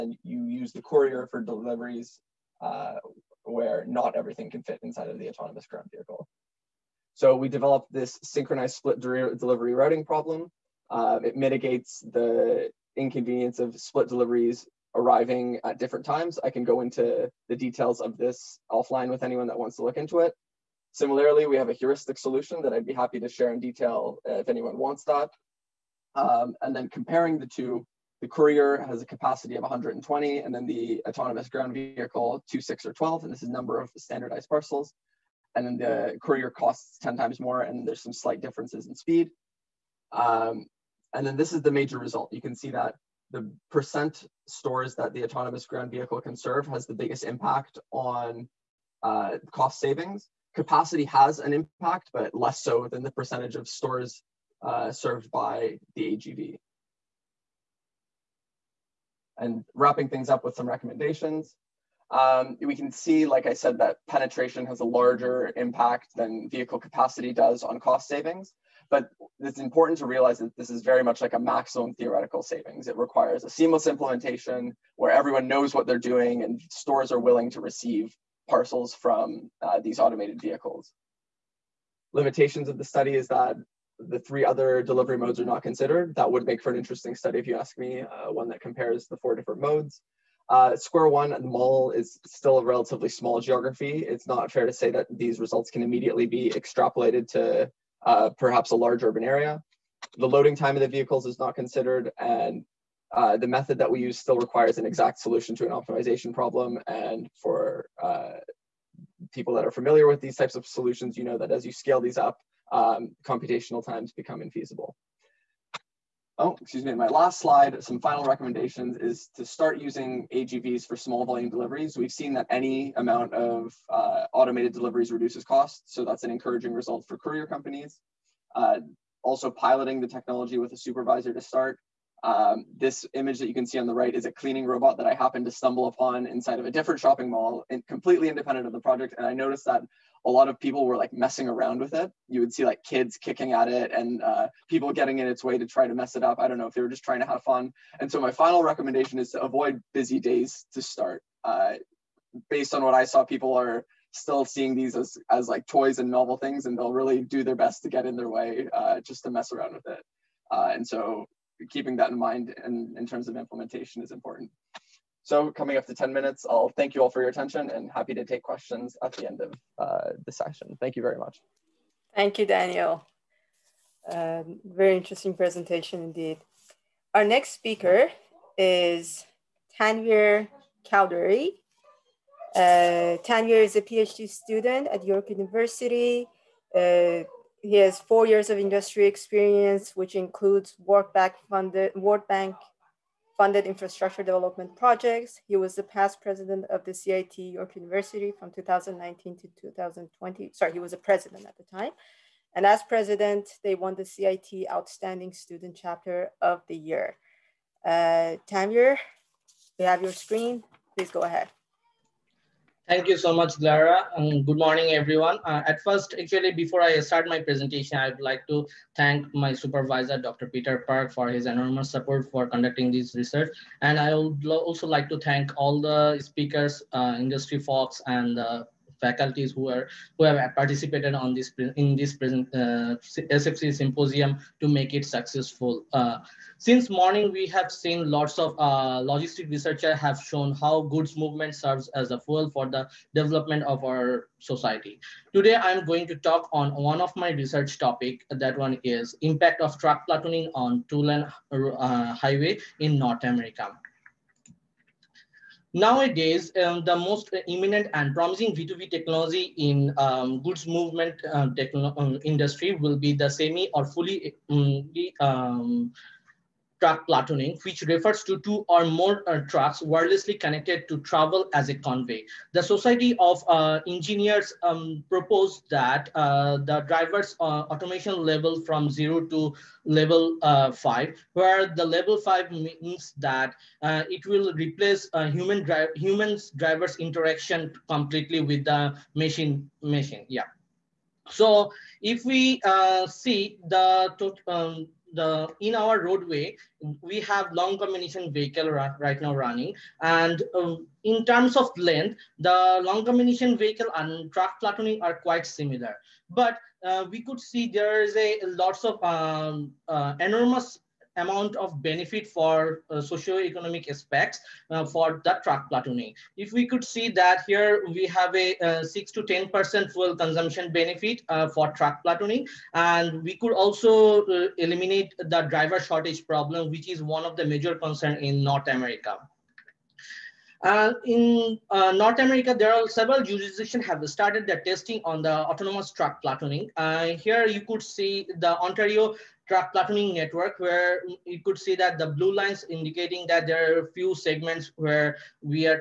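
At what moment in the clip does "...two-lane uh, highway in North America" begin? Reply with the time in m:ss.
4:10.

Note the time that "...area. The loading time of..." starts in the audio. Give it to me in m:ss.
1:39.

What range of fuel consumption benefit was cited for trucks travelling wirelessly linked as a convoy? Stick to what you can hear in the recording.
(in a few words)
6 to 10%.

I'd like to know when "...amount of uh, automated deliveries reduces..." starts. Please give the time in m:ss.
2:02.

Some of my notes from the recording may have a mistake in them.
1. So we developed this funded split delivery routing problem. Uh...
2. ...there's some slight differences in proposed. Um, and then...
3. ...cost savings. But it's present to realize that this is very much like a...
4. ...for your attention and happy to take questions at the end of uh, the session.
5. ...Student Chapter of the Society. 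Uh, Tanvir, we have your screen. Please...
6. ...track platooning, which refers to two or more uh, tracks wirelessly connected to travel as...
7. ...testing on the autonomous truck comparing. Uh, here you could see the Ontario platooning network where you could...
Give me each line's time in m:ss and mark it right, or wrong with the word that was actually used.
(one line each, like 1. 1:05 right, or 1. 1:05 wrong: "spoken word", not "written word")
1. 0:07 wrong: "synchronized", not "funded"
2. 0:37 wrong: "speed", not "proposed"
3. 1:07 wrong: "important", not "present"
4. 2:47 right
5. 3:25 wrong: "Year", not "Society"
6. 4:26 right
7. 5:34 wrong: "platooning", not "comparing".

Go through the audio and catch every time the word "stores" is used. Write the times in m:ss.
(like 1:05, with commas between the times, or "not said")
0:44, 0:53, 1:16.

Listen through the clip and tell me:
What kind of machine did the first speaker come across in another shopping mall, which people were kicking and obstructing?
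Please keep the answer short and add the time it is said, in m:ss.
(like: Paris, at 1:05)
cleaning robot, at 2:14.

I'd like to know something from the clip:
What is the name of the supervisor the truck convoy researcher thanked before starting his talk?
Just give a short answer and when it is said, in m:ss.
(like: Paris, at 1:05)
Dr. Peter Park, at 3:40.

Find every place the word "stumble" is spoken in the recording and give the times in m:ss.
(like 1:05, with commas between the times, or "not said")
2:15.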